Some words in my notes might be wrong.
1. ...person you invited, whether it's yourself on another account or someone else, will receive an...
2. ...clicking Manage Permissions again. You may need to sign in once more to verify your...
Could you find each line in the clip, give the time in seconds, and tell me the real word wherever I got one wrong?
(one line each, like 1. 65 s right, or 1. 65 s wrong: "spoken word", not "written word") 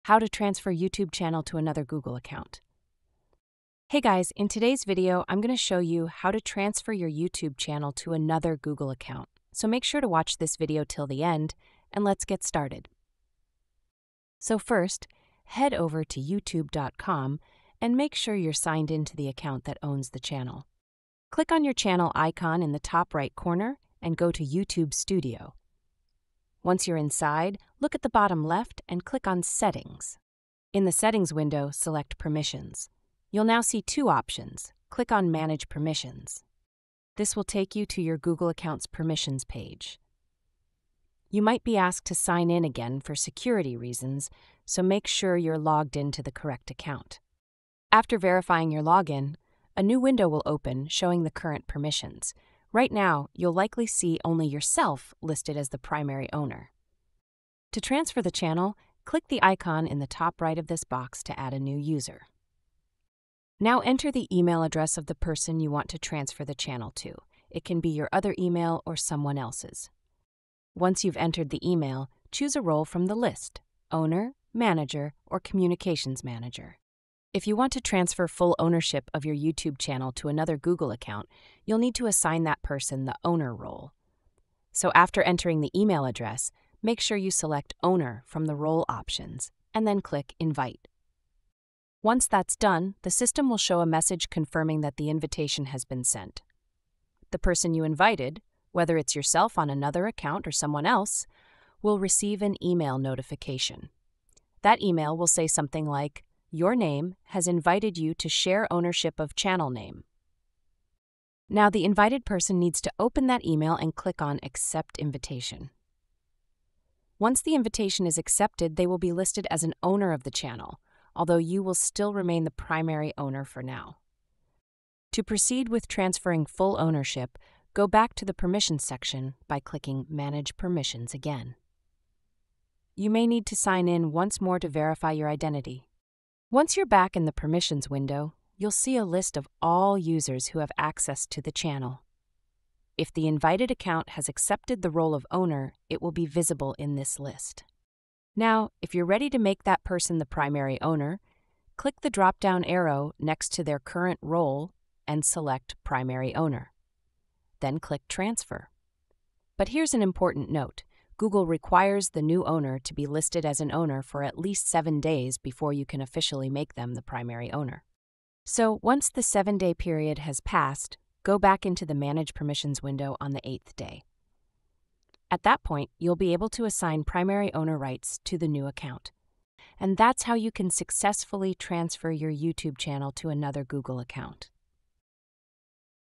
1. 97 s right
2. 129 s right.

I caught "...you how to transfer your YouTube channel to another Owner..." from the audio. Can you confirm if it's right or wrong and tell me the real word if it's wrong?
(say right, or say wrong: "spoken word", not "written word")
wrong: "Google", not "Owner".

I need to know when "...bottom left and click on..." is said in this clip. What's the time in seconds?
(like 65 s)
28 s.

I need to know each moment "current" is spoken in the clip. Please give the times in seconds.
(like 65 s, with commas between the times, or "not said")
51 s, 153 s.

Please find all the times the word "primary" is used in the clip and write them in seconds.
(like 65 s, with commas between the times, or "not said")
55 s, 122 s, 150 s, 155 s, 167 s, 177 s.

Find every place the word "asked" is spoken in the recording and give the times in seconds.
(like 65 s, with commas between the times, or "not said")
41 s.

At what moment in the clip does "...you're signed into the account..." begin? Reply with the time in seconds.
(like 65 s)
18 s.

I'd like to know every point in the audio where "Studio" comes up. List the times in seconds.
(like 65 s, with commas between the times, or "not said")
24 s.